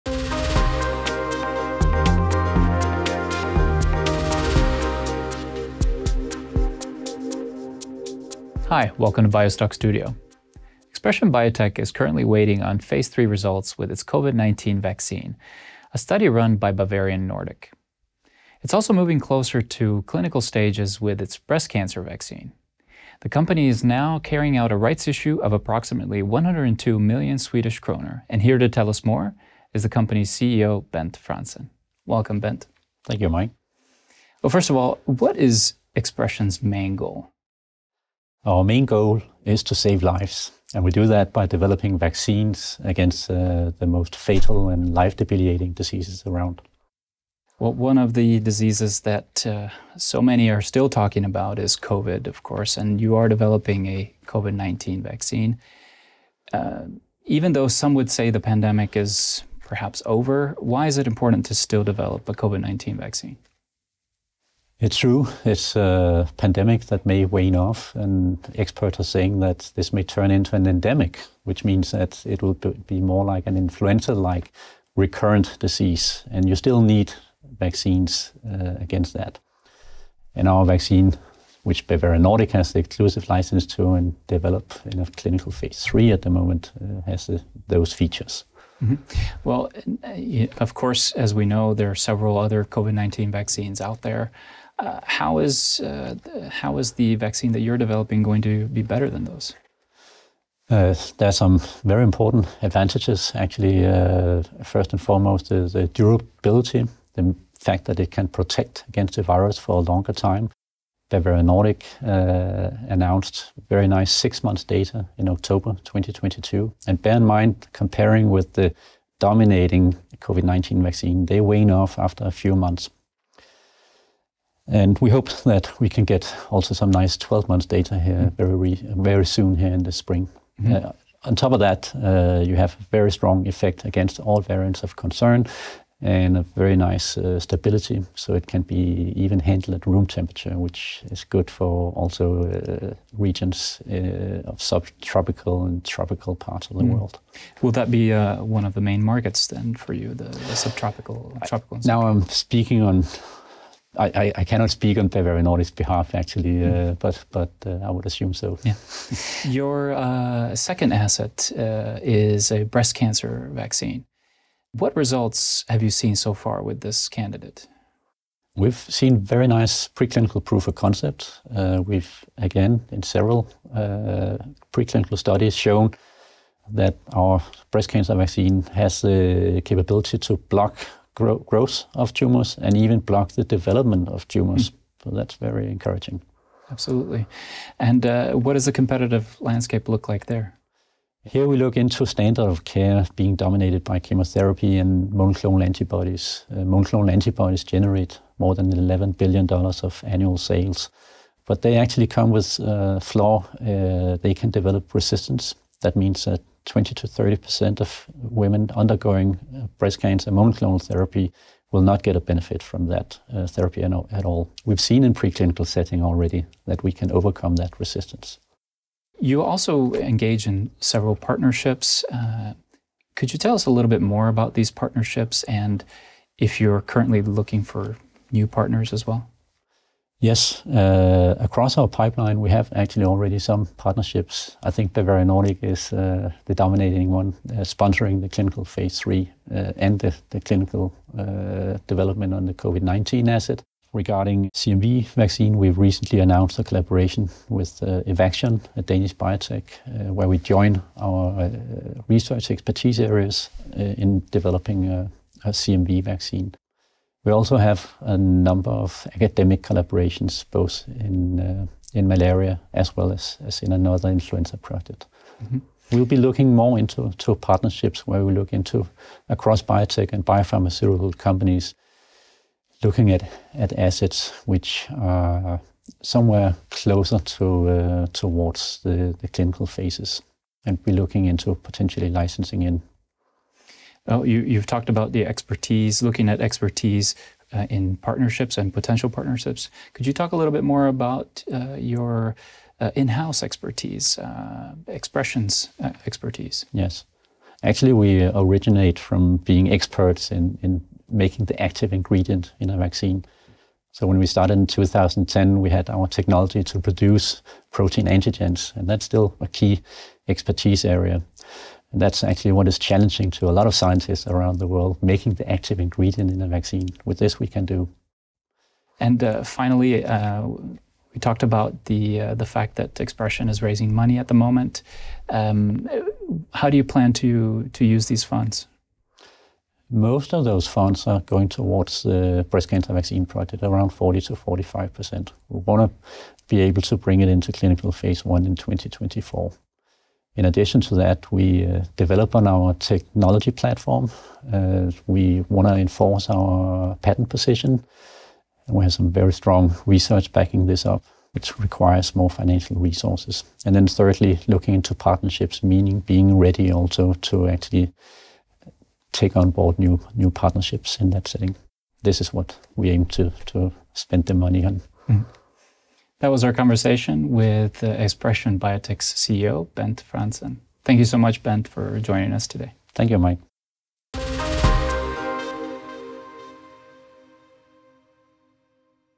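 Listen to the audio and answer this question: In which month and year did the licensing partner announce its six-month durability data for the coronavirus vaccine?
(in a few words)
October 2022.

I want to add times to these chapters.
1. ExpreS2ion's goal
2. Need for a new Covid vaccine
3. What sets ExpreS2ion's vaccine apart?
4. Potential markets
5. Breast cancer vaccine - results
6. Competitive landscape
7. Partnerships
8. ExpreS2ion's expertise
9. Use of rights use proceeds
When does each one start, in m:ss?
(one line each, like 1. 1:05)
1. 0:33
2. 0:47
3. 1:30
4. 2:27
5. 2:39
6. 3:07
7. 3:39
8. 4:43
9. 5:18.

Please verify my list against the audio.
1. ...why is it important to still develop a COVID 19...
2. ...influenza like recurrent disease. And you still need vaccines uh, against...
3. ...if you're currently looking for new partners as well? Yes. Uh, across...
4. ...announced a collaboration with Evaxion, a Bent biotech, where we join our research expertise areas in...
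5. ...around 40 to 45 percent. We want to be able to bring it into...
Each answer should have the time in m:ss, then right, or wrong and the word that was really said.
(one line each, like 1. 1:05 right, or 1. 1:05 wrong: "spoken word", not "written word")
1. 1:00 right
2. 1:13 right
3. 3:46 right
4. 4:06 wrong: "Danish", not "Bent"
5. 5:33 right.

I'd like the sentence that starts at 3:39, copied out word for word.
You also engage in several partnerships.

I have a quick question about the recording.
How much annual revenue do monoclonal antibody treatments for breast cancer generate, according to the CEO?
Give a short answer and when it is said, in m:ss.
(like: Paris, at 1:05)
More than $11 billion, at 3:18.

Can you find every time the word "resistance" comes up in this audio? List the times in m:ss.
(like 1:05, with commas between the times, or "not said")
3:24, 3:37.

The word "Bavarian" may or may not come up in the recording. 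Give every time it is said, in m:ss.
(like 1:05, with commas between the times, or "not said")
0:16, 1:21, 1:51, 2:35, 3:54.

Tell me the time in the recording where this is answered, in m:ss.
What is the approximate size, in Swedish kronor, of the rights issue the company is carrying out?
0:26.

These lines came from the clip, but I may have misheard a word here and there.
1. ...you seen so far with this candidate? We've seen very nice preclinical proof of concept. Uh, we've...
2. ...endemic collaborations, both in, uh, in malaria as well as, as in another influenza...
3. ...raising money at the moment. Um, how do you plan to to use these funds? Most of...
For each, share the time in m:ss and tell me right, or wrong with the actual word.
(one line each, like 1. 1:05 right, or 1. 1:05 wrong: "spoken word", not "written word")
1. 2:45 right
2. 4:19 wrong: "academic", not "endemic"
3. 5:23 right.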